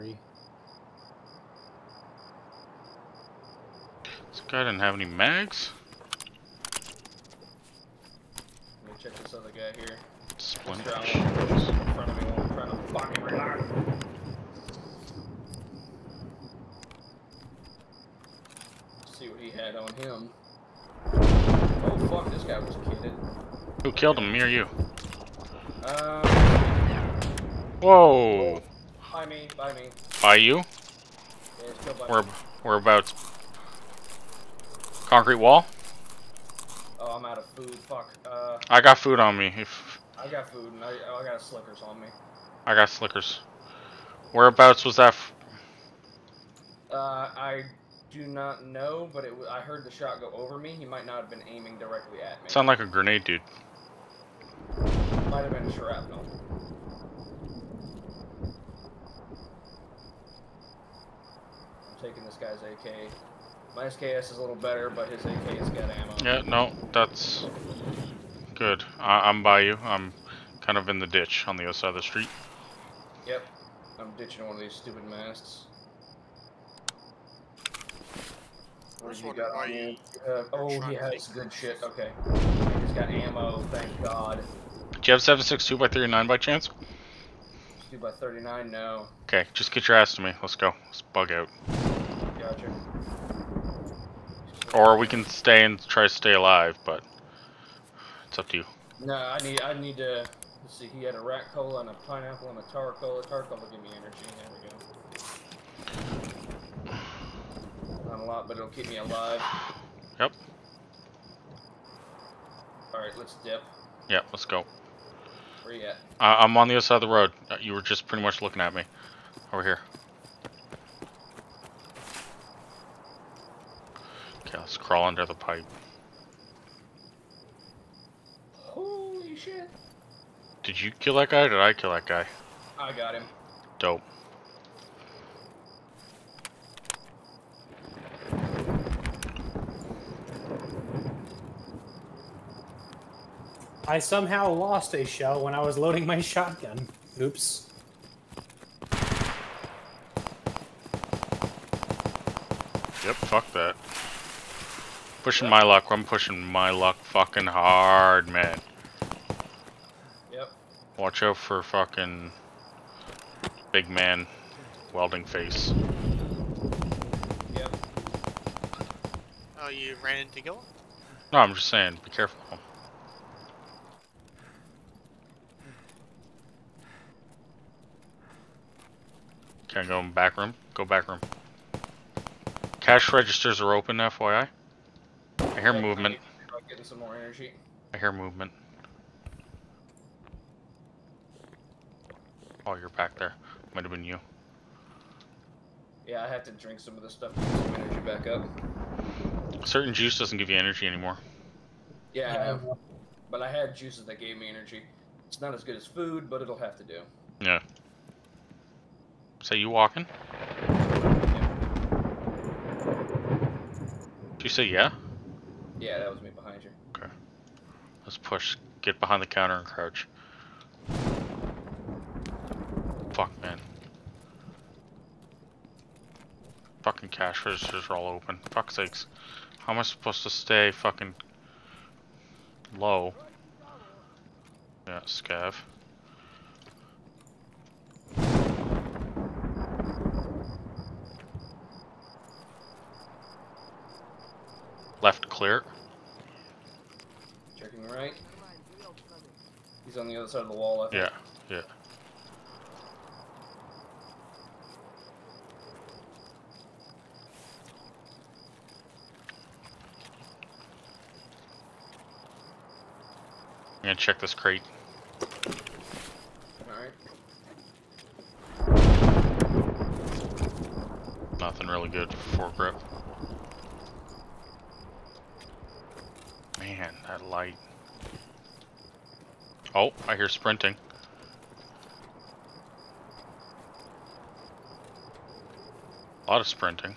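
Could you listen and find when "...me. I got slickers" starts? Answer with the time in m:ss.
0:41.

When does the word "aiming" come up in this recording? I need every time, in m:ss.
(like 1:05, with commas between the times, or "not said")
0:51.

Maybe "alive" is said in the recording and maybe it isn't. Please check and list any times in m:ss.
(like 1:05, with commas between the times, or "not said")
1:36, 1:48.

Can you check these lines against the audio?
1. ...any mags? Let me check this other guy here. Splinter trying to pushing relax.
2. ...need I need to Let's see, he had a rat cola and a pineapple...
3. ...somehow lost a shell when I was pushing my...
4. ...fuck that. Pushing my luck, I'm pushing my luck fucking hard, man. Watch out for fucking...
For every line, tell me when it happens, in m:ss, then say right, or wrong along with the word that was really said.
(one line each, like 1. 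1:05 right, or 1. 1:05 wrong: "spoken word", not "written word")
1. 0:04 wrong: "fucking", not "pushing"
2. 1:39 right
3. 2:23 wrong: "loading", not "pushing"
4. 2:33 right.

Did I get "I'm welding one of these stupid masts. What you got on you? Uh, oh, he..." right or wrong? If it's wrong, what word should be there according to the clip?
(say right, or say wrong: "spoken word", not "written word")
wrong: "ditching", not "welding".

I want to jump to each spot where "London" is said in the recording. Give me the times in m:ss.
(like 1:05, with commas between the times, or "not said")
not said.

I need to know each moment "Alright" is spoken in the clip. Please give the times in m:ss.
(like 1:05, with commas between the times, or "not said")
1:52, 4:26.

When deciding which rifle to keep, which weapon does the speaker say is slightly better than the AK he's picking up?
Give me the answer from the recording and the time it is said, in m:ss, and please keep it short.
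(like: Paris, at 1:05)
SKS, at 1:03.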